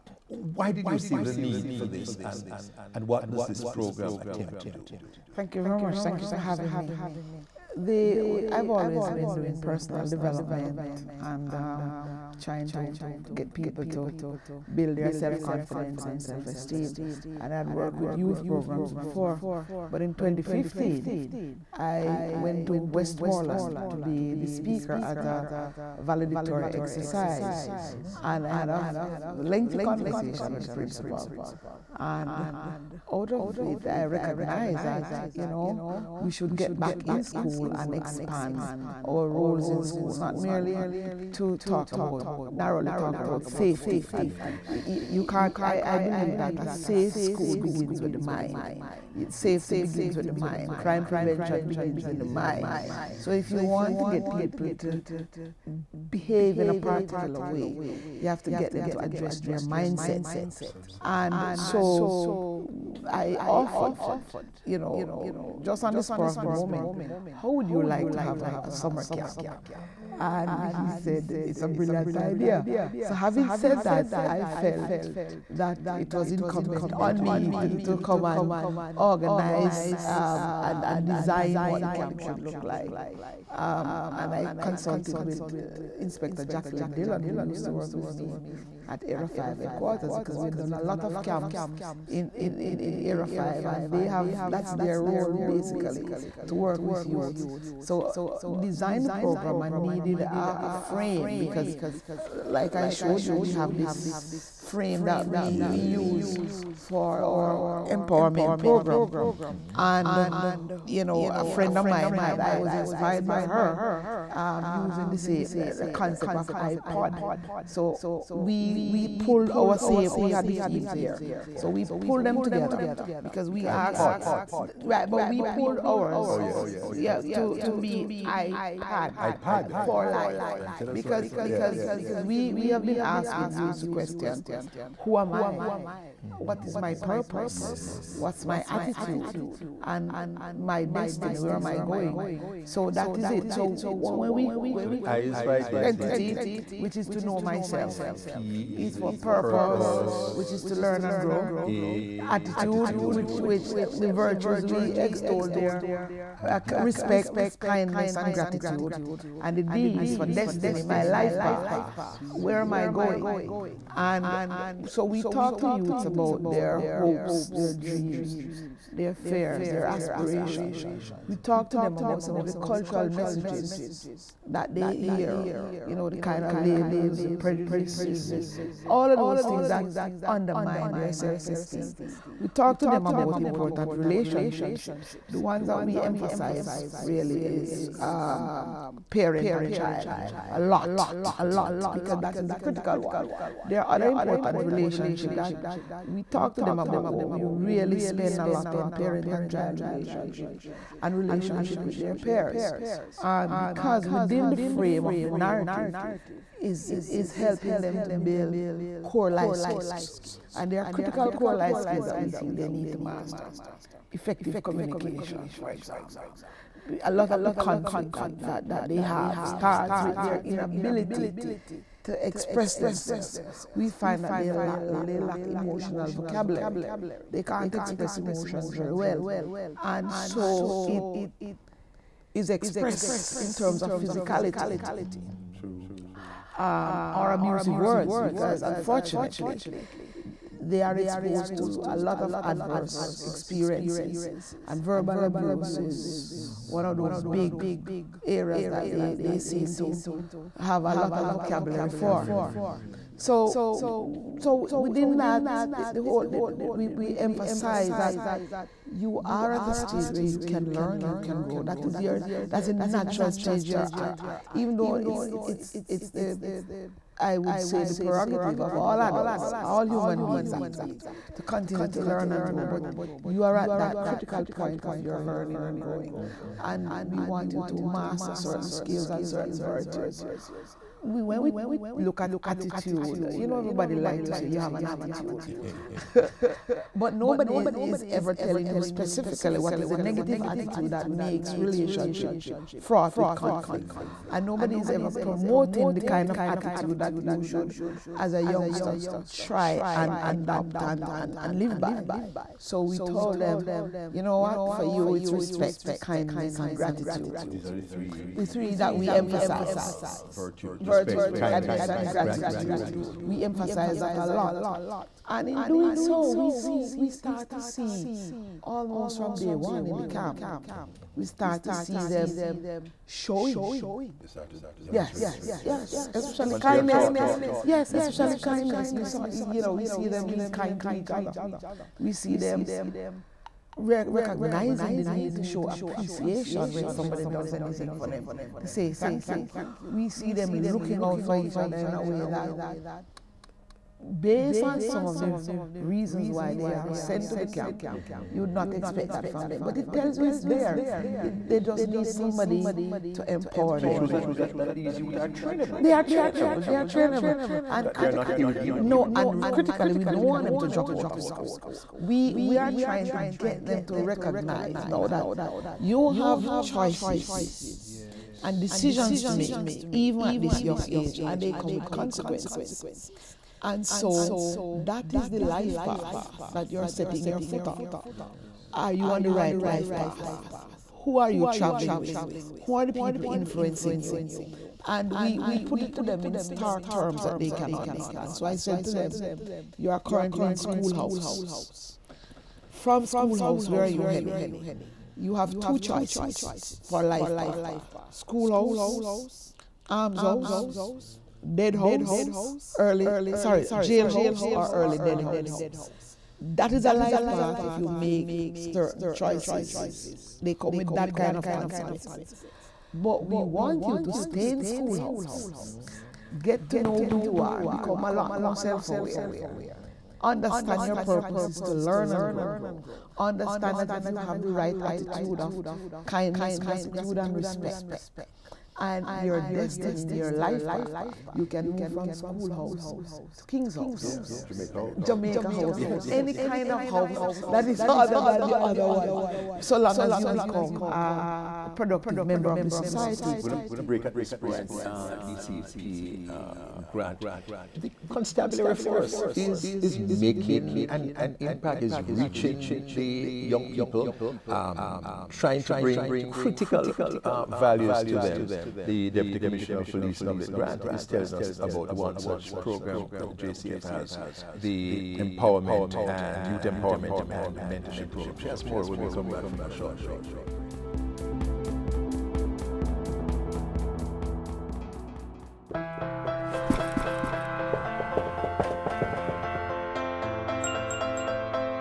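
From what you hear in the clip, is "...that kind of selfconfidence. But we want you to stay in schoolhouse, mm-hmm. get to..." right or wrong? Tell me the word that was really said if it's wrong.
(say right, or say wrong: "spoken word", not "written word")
wrong: "consequence", not "selfconfidence".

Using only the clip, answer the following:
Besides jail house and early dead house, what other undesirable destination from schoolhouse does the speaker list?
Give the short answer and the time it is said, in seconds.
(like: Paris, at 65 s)
arms house, at 399 s.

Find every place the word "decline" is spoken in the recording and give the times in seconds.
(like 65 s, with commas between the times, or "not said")
not said.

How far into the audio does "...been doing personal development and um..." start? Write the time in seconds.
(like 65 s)
9 s.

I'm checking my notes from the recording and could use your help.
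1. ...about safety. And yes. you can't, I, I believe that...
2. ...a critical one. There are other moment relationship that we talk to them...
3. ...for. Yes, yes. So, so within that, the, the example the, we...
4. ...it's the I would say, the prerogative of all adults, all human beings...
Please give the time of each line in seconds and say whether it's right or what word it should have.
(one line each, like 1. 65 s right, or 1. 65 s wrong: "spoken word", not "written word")
1. 43 s right
2. 192 s wrong: "important", not "moment"
3. 251 s wrong: "whole", not "example"
4. 265 s right.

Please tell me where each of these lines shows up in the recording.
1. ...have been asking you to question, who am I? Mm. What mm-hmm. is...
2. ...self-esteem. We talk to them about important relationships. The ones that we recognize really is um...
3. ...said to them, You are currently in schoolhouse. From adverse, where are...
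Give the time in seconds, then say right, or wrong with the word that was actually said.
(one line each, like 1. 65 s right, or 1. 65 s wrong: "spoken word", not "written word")
1. 132 s right
2. 181 s wrong: "emphasize", not "recognize"
3. 388 s wrong: "schoolhouse", not "adverse".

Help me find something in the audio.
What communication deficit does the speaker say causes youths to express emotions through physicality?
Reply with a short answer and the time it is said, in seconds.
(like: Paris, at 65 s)
emotional vocabulary, at 225 s.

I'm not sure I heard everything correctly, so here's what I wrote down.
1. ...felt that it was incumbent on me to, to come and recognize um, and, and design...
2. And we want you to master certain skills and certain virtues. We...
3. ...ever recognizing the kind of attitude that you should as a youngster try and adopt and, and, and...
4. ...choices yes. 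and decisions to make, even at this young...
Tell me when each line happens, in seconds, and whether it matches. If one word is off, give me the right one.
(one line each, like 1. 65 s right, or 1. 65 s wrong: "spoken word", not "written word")
1. 74 s wrong: "organize", not "recognize"
2. 276 s right
3. 294 s wrong: "promoting", not "recognizing"
4. 366 s right.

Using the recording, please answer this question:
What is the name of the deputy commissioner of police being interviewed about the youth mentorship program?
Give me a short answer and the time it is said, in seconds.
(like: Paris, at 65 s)
Novlet Grant, at 460 s.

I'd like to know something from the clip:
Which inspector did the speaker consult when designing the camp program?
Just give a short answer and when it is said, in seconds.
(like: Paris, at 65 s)
Jacqueline Dillon, at 86 s.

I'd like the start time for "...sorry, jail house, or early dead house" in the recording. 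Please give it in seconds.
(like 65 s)
403 s.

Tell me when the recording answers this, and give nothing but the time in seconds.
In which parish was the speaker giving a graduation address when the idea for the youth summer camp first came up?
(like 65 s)
22 s.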